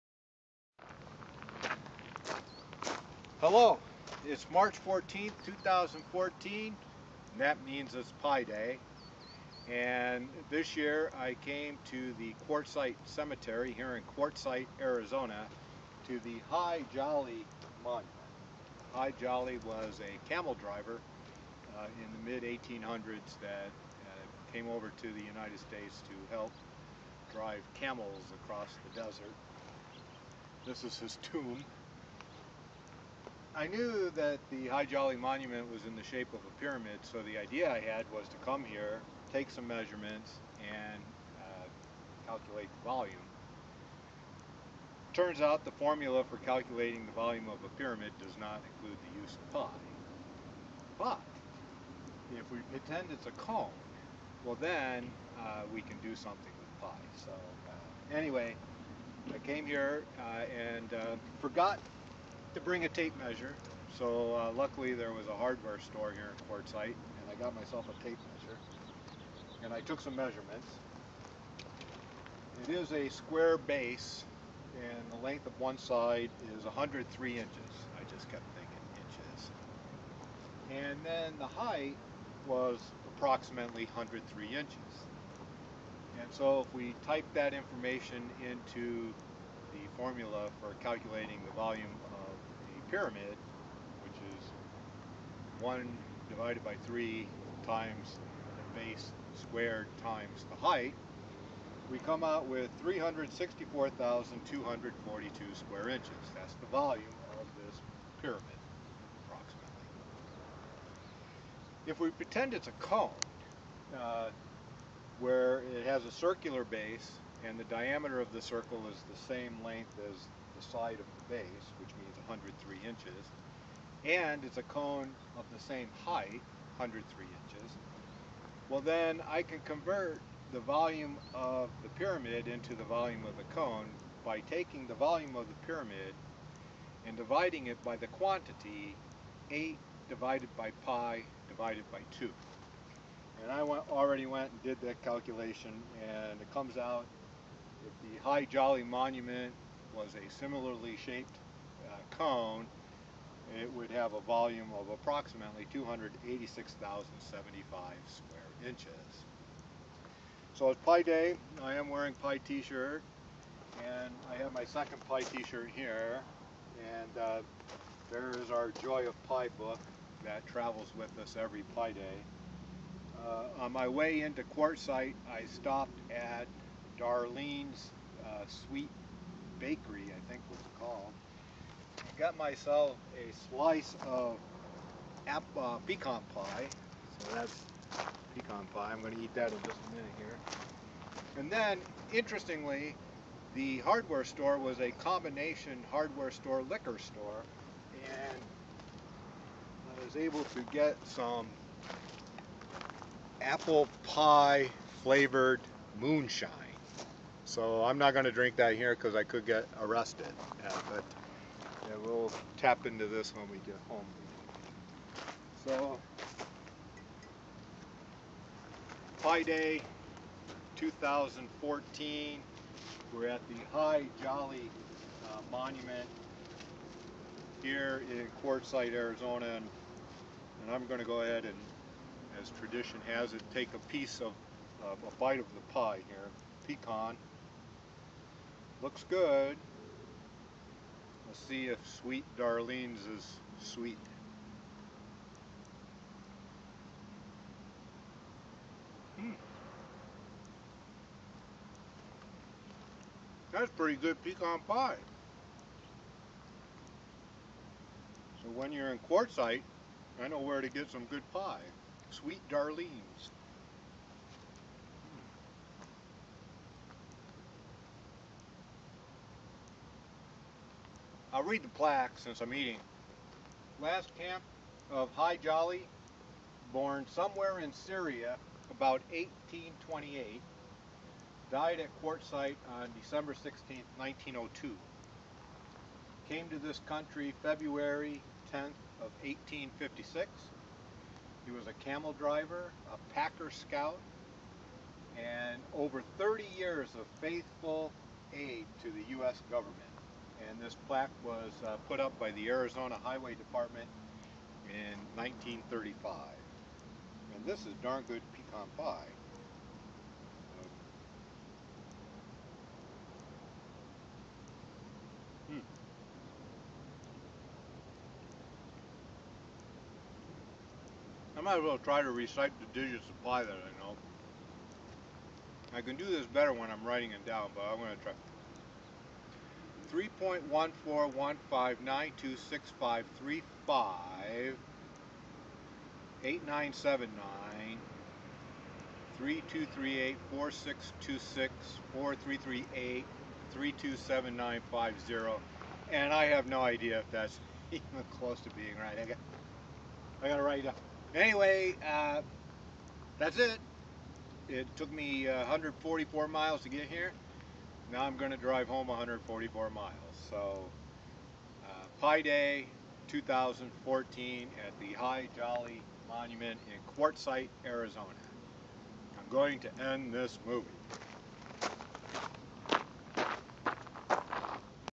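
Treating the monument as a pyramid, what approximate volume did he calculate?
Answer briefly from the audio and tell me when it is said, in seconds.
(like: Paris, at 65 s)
364,242 square inches, at 102 s.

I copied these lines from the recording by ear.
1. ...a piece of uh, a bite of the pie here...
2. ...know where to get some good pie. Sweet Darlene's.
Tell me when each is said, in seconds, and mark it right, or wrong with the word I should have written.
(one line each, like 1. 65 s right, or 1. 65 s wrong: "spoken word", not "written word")
1. 233 s right
2. 260 s right.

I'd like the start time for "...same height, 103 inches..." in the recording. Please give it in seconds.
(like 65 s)
125 s.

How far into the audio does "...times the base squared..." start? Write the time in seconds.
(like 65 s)
97 s.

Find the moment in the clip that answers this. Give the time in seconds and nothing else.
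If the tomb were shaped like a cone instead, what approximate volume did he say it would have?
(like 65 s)
155 s.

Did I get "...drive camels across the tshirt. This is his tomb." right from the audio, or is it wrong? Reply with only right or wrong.
wrong.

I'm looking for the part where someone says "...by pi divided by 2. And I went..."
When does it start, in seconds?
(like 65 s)
140 s.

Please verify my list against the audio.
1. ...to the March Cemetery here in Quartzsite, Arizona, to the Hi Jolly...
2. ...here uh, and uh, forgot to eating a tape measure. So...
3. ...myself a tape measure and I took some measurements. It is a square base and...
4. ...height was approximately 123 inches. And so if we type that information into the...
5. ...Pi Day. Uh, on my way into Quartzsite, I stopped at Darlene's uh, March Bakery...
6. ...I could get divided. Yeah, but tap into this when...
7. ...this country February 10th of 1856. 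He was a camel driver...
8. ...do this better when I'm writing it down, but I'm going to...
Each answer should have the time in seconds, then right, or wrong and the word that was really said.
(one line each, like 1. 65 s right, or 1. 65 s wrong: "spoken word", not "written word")
1. 11 s wrong: "Quartzsite", not "March"
2. 59 s wrong: "bring", not "eating"
3. 67 s right
4. 81 s wrong: "103", not "123"
5. 171 s wrong: "Sweet", not "March"
6. 209 s wrong: "arrested", not "divided"
7. 286 s right
8. 325 s right.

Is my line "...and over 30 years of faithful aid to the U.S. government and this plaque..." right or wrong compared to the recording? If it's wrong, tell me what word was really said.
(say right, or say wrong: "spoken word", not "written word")
right.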